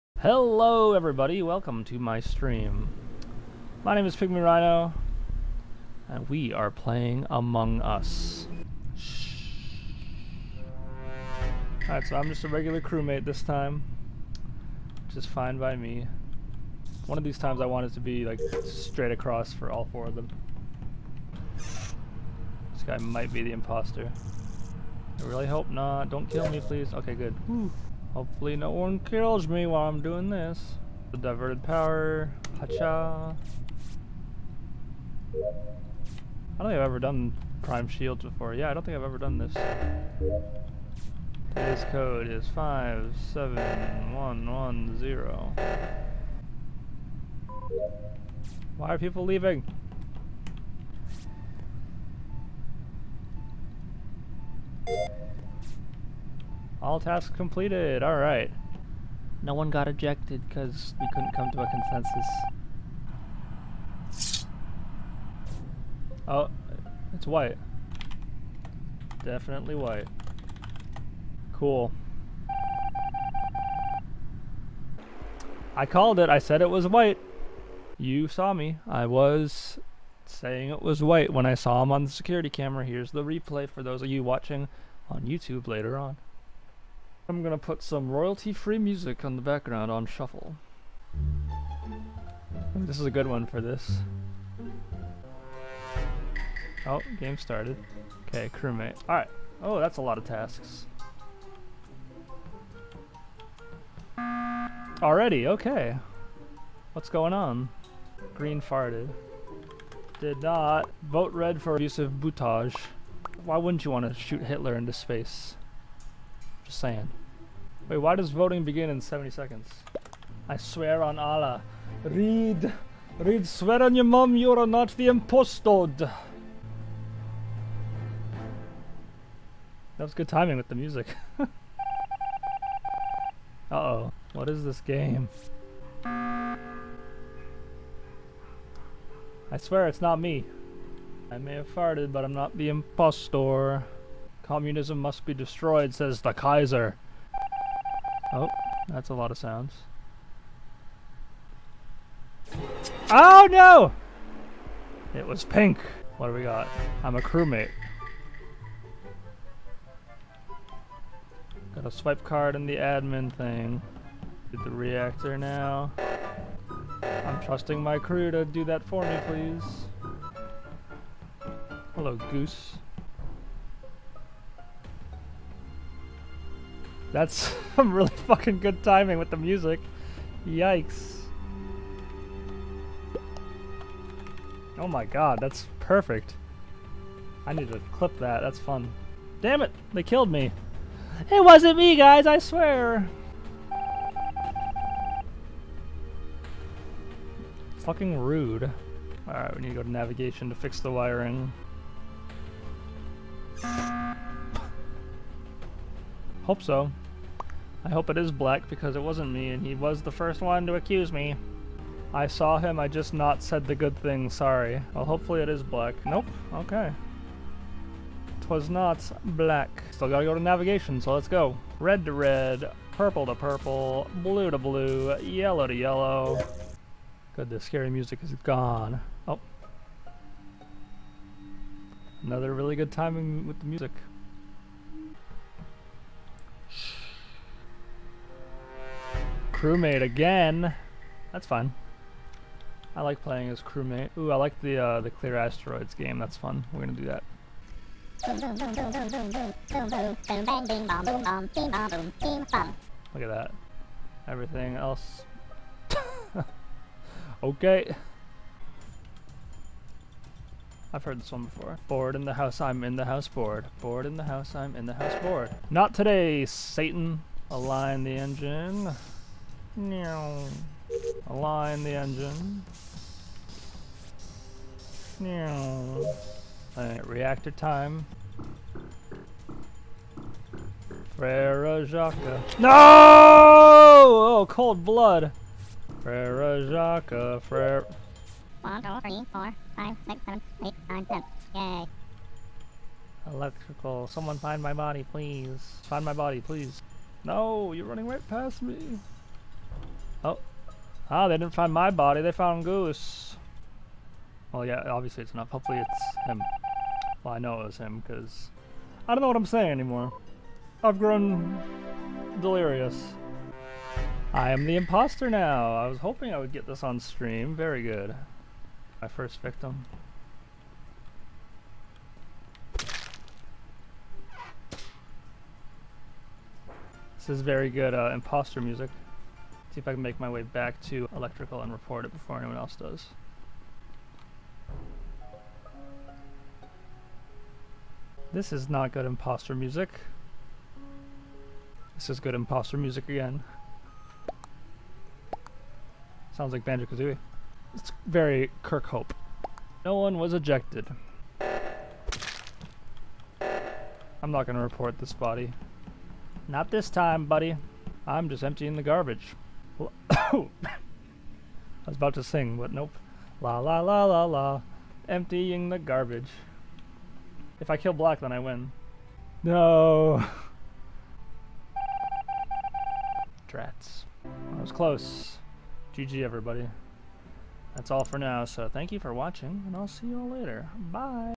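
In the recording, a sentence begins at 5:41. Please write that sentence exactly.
This is good imposter music again.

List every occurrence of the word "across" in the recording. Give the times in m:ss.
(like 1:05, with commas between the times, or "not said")
0:19.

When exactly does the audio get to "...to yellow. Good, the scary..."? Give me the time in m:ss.
3:45.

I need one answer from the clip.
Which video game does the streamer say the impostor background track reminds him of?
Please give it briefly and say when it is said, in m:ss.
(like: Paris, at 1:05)
Banjo-Kazooie, at 5:46.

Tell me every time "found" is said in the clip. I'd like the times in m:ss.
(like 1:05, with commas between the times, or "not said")
5:02.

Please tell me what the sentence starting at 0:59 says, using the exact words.
No one got ejected because we couldn't come to a consensus.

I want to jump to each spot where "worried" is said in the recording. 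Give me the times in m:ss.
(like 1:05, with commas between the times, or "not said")
not said.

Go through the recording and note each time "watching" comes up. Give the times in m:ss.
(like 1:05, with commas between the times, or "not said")
1:24, 6:19.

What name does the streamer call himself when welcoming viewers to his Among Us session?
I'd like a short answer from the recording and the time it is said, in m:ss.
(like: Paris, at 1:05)
Pigmy Rhino, at 0:04.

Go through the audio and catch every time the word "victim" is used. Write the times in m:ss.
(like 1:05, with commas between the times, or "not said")
5:19.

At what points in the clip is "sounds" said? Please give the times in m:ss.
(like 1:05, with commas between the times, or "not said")
2:29, 5:46.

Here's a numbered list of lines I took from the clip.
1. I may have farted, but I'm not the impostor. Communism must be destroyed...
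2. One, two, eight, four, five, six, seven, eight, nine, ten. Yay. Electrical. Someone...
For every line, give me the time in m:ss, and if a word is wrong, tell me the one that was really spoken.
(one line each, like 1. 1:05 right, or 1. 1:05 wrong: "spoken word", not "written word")
1. 2:21 right
2. 4:48 wrong: "three", not "eight".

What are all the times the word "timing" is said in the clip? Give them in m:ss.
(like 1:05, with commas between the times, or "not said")
2:10, 2:58, 3:52.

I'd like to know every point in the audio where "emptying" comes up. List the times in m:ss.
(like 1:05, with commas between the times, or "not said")
5:58, 6:05.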